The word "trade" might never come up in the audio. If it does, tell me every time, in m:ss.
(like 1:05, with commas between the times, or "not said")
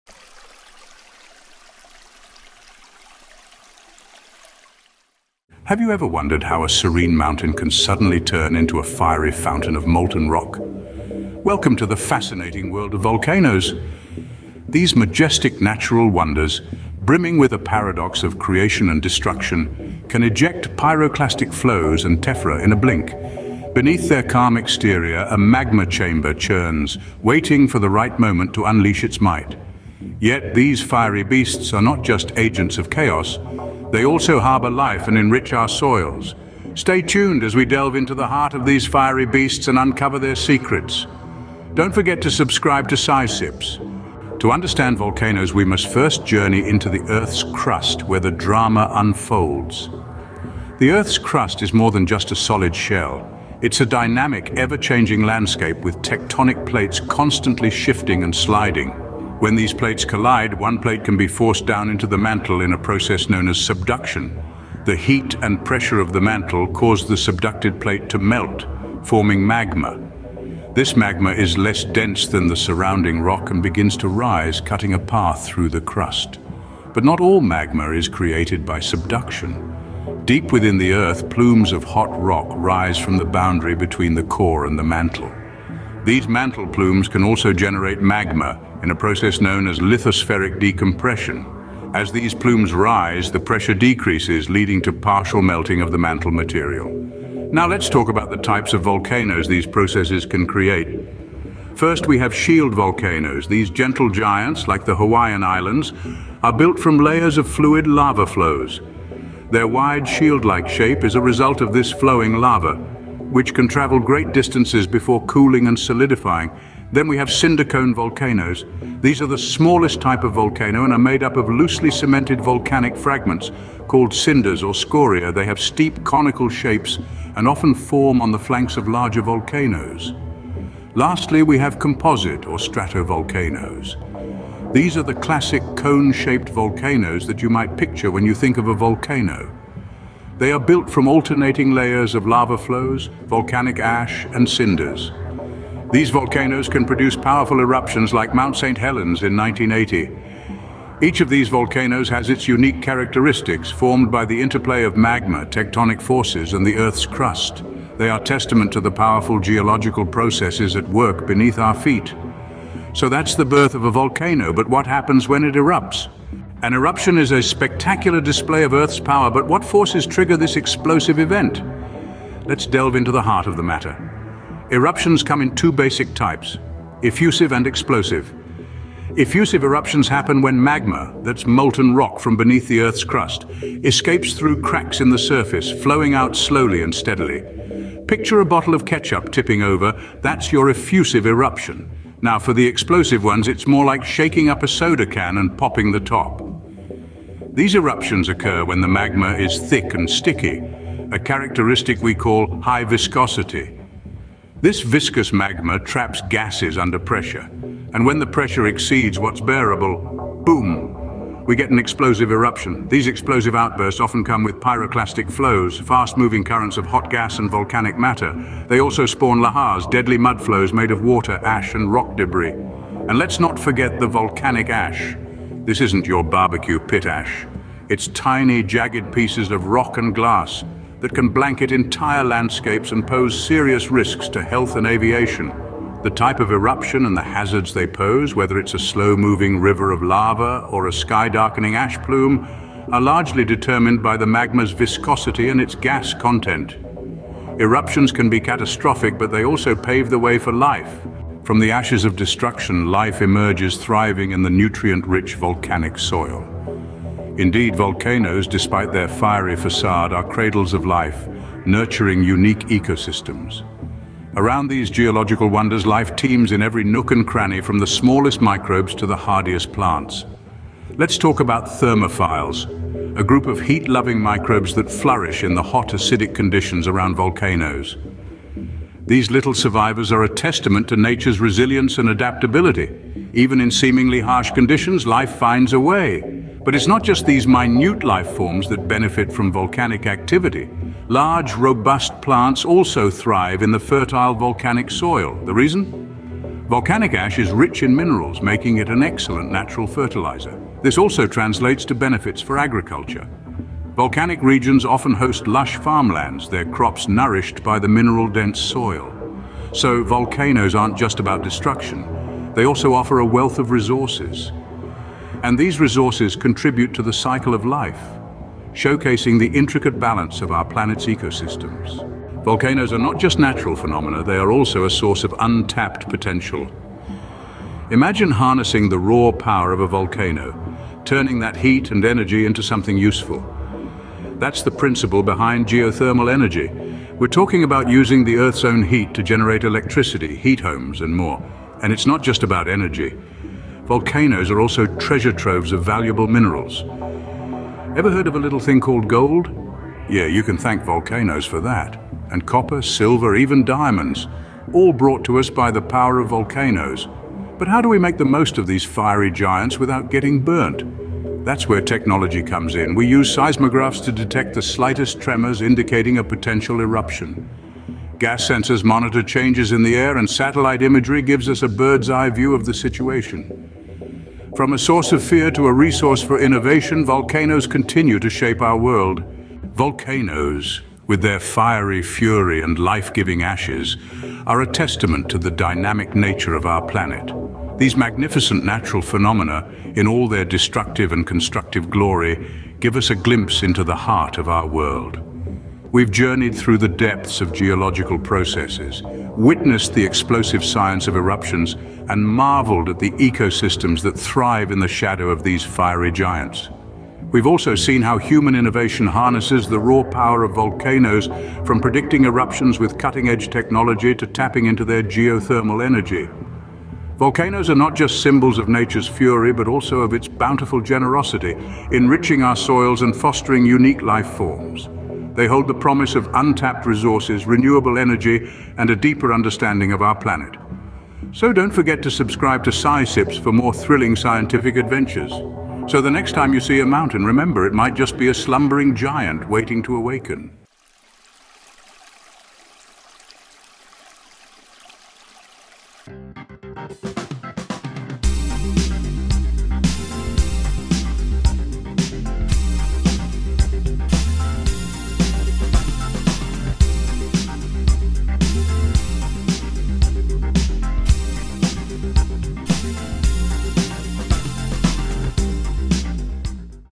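not said.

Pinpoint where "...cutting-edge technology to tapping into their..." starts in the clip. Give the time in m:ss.
6:52.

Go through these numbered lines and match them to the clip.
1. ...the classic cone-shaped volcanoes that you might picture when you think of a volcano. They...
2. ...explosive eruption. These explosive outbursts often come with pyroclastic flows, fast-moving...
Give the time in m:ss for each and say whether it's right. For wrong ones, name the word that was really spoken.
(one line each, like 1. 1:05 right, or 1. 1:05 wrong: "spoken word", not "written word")
1. 2:15 right
2. 3:31 right.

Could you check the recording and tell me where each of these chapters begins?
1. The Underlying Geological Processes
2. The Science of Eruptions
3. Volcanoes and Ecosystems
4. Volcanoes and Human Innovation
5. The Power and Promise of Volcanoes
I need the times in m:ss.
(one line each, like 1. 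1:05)
1. 0:38
2. 2:40
3. 4:05
4. 5:16
5. 6:14.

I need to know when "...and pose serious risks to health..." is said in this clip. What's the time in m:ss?
3:52.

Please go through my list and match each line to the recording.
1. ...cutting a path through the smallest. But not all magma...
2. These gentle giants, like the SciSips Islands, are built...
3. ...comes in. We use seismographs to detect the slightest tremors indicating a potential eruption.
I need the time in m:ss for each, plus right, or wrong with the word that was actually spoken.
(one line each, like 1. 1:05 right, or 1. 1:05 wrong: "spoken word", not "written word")
1. 1:14 wrong: "crust", not "smallest"
2. 1:43 wrong: "Hawaiian", not "SciSips"
3. 6:02 right.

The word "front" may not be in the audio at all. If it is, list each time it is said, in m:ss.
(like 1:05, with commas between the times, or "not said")
not said.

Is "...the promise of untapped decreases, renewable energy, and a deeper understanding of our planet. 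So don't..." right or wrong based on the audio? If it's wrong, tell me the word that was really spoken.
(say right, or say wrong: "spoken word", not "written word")
wrong: "resources", not "decreases".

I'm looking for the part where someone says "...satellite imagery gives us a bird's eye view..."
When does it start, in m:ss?
6:10.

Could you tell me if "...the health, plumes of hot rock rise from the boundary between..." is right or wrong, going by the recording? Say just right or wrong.
wrong.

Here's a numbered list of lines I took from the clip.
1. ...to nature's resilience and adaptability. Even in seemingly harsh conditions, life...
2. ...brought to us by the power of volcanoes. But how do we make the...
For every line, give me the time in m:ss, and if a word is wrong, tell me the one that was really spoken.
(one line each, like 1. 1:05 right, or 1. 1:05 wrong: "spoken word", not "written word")
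1. 4:40 right
2. 5:54 right.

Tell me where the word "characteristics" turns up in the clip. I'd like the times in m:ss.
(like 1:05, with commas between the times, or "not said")
2:32, 3:21.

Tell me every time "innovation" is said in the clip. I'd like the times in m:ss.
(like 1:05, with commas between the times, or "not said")
6:16, 6:48.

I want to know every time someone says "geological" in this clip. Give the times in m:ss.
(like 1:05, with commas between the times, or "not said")
2:39, 4:24, 6:37.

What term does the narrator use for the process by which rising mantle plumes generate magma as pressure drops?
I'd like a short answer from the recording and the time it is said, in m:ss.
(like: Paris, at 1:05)
lithospheric decompression, at 1:29.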